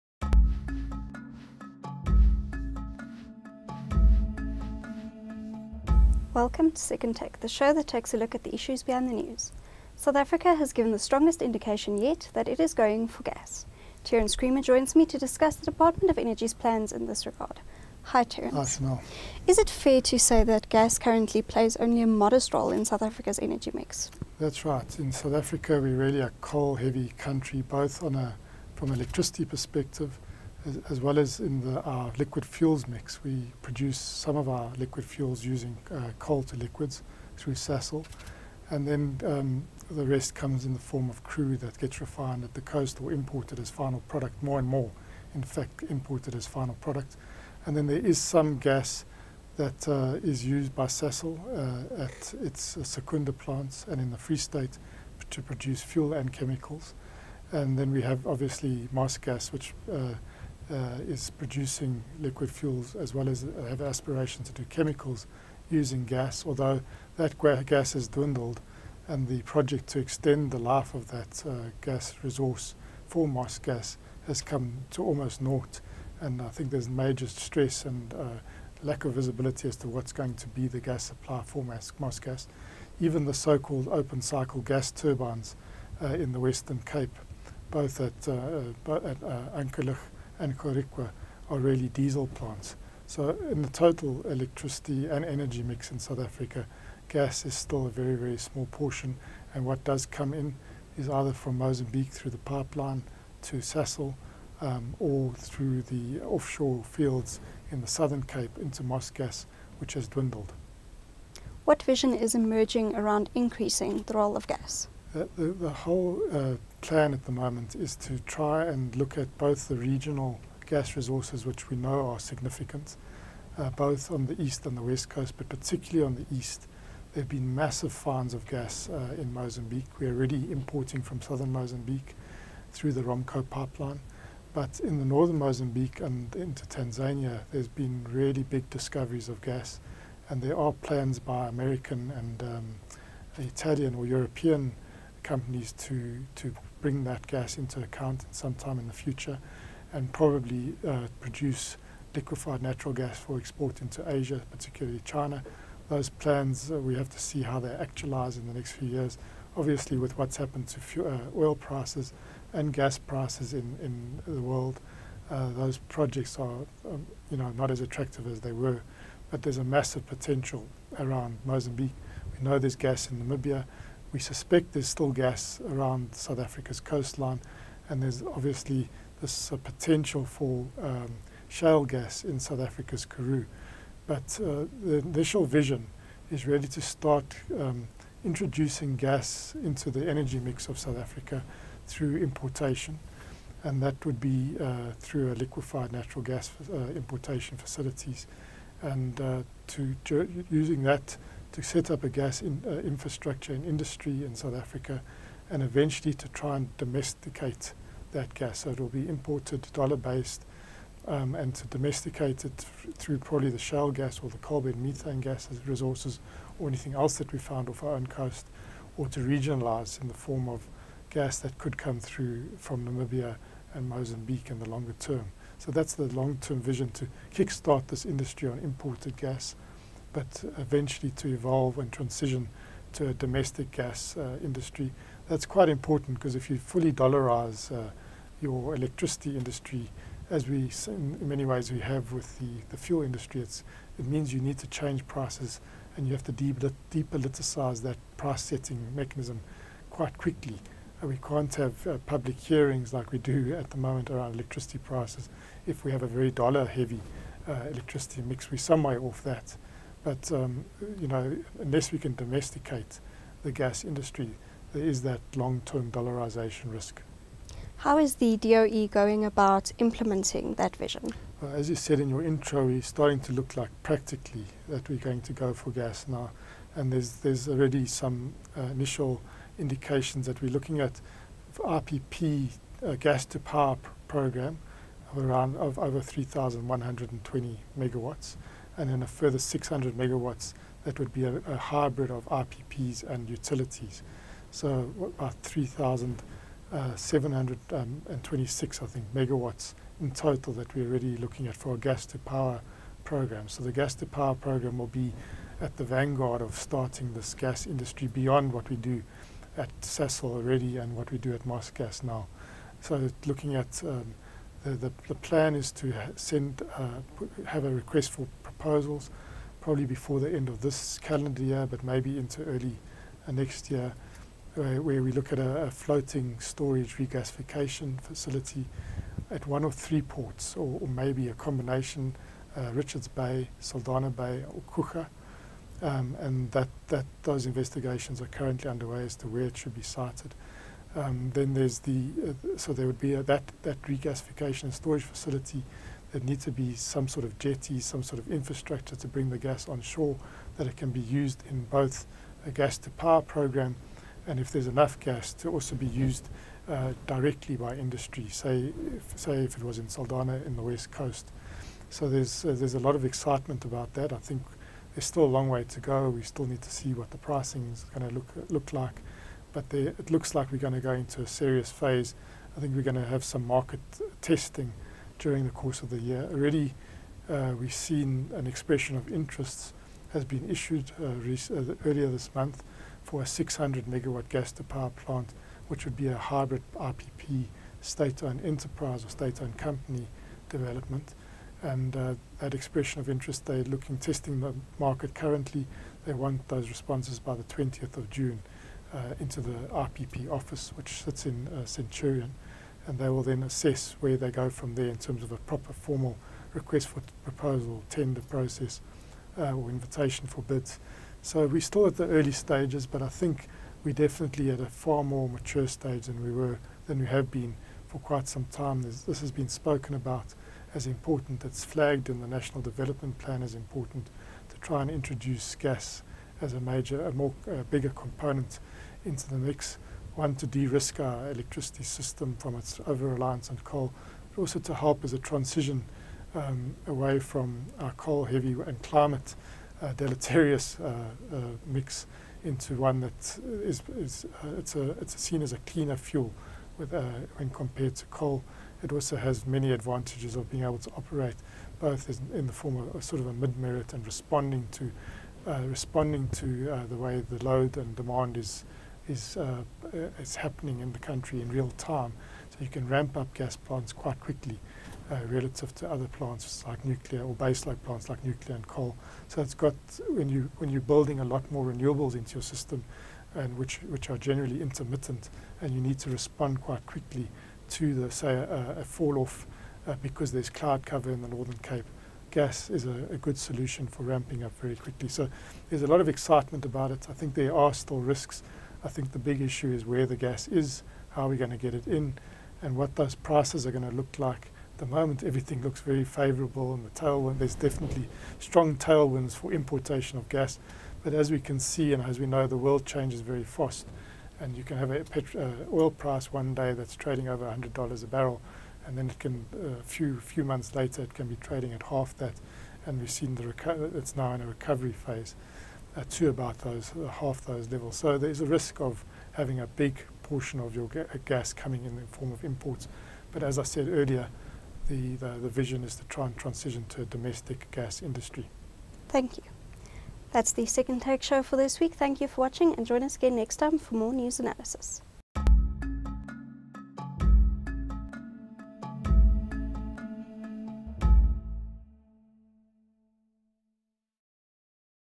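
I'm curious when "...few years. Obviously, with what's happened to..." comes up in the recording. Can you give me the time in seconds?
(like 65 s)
158 s.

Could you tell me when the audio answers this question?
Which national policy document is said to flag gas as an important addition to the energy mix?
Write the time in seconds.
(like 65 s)
422 s.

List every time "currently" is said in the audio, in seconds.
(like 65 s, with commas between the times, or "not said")
20 s, 338 s, 395 s.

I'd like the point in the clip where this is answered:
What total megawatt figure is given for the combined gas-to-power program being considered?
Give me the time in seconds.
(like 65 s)
295 s.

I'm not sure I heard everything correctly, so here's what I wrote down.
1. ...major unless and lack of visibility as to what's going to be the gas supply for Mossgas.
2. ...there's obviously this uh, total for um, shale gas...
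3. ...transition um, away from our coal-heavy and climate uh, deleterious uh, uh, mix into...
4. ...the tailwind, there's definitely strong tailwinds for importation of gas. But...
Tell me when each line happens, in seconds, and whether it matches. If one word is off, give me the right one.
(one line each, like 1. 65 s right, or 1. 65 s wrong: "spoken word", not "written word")
1. 76 s wrong: "stress", not "unless"
2. 178 s wrong: "potential", not "total"
3. 435 s right
4. 496 s right.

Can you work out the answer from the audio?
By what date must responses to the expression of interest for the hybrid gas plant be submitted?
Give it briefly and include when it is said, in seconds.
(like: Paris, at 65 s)
20 June, at 397 s.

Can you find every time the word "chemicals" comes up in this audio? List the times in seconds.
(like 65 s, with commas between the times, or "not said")
56 s, 64 s.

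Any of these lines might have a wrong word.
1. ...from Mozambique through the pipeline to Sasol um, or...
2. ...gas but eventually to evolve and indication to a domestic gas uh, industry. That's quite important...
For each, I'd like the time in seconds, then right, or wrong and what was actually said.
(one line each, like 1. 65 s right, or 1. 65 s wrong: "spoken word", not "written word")
1. 101 s right
2. 229 s wrong: "transition", not "indication".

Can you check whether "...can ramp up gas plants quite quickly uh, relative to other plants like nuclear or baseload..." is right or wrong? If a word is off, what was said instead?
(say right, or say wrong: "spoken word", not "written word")
right.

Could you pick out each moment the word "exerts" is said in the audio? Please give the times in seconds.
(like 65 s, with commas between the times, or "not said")
not said.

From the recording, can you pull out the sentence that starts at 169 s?
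But there's a massive potential around Mozambique.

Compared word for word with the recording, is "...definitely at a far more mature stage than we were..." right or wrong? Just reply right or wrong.
right.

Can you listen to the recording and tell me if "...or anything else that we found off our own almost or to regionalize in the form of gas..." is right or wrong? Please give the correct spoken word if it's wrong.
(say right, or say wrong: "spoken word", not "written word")
wrong: "coast", not "almost".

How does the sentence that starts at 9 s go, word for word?
South Africa has given the strongest indication yet that it is going for gas.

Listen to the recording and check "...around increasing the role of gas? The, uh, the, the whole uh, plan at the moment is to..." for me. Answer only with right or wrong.
right.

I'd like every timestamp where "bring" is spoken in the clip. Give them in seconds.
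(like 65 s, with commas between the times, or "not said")
146 s, 349 s.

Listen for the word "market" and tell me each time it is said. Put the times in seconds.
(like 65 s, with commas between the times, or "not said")
373 s, 394 s.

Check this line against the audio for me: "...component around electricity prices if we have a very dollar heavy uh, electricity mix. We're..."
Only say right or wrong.
wrong.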